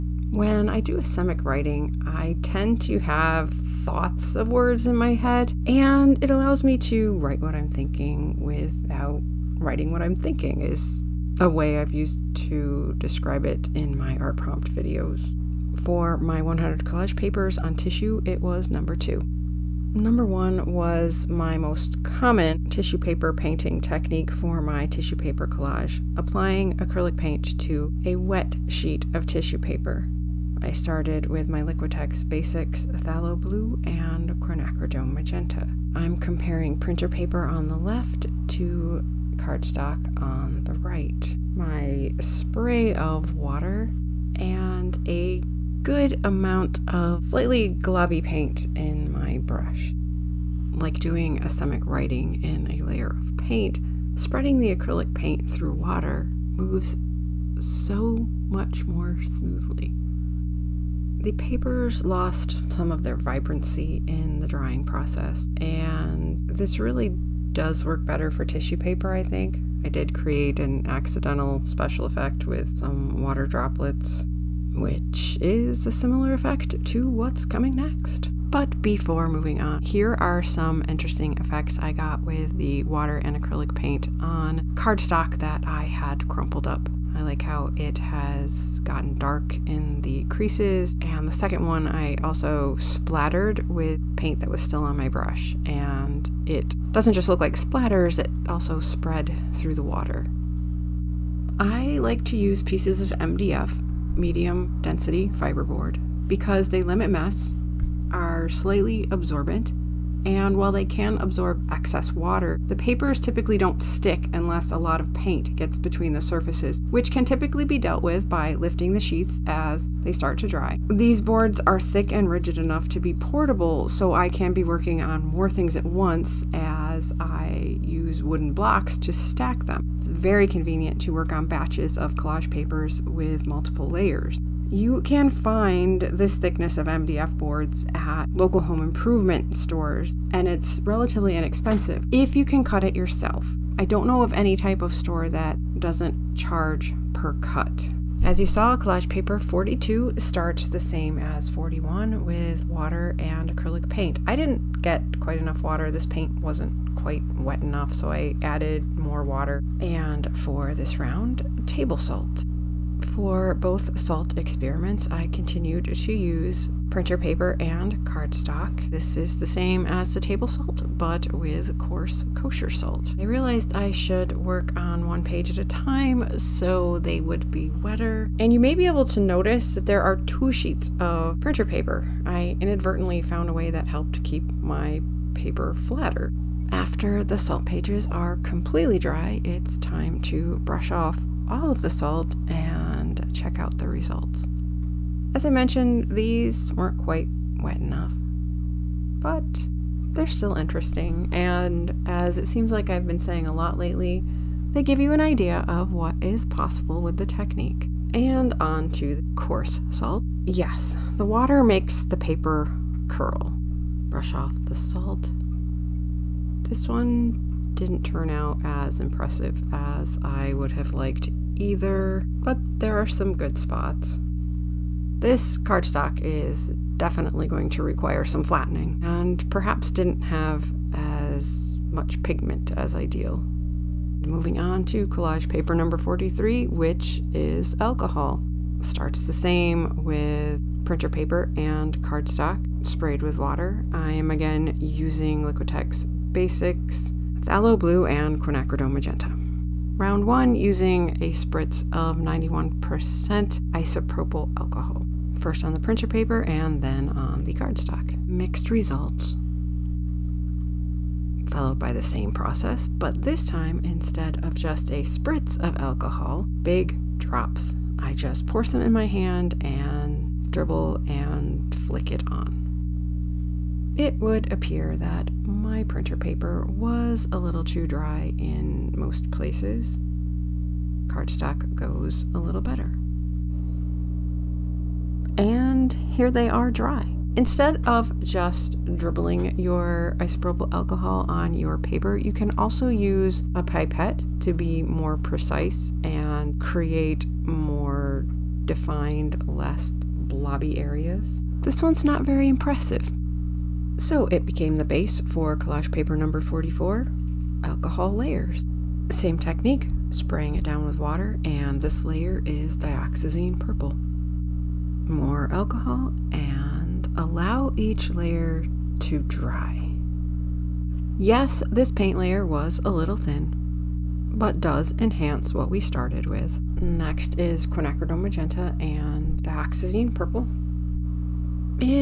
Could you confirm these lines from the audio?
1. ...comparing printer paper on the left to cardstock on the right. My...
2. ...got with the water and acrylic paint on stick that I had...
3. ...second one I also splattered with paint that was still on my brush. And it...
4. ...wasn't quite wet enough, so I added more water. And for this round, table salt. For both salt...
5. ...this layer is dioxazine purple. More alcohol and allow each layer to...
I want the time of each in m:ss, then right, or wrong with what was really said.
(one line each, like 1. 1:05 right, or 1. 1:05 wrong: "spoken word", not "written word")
1. 0:36 right
2. 1:21 wrong: "cardstock", not "stick"
3. 1:31 right
4. 2:36 right
5. 5:11 right.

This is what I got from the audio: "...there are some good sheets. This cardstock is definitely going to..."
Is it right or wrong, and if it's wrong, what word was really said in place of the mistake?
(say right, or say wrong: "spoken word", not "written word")
wrong: "spots", not "sheets".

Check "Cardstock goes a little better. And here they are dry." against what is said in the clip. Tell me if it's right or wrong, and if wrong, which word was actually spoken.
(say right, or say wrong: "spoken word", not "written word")
right.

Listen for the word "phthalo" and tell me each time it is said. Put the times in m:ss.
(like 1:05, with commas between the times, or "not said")
0:32, 4:07.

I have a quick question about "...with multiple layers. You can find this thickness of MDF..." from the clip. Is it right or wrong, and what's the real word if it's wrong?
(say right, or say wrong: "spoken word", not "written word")
right.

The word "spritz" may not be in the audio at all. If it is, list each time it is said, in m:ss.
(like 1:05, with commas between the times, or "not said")
4:11, 4:25.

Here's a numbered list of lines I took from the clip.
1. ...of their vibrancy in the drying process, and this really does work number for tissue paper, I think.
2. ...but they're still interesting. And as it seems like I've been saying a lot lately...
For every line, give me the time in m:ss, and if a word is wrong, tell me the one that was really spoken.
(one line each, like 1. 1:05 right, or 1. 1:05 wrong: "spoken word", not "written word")
1. 1:02 wrong: "better", not "number"
2. 3:19 right.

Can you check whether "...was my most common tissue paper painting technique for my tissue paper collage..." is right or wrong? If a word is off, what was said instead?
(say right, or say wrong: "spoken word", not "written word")
right.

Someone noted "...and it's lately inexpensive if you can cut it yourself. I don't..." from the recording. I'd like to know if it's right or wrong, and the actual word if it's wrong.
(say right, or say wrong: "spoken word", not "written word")
wrong: "relatively", not "lately".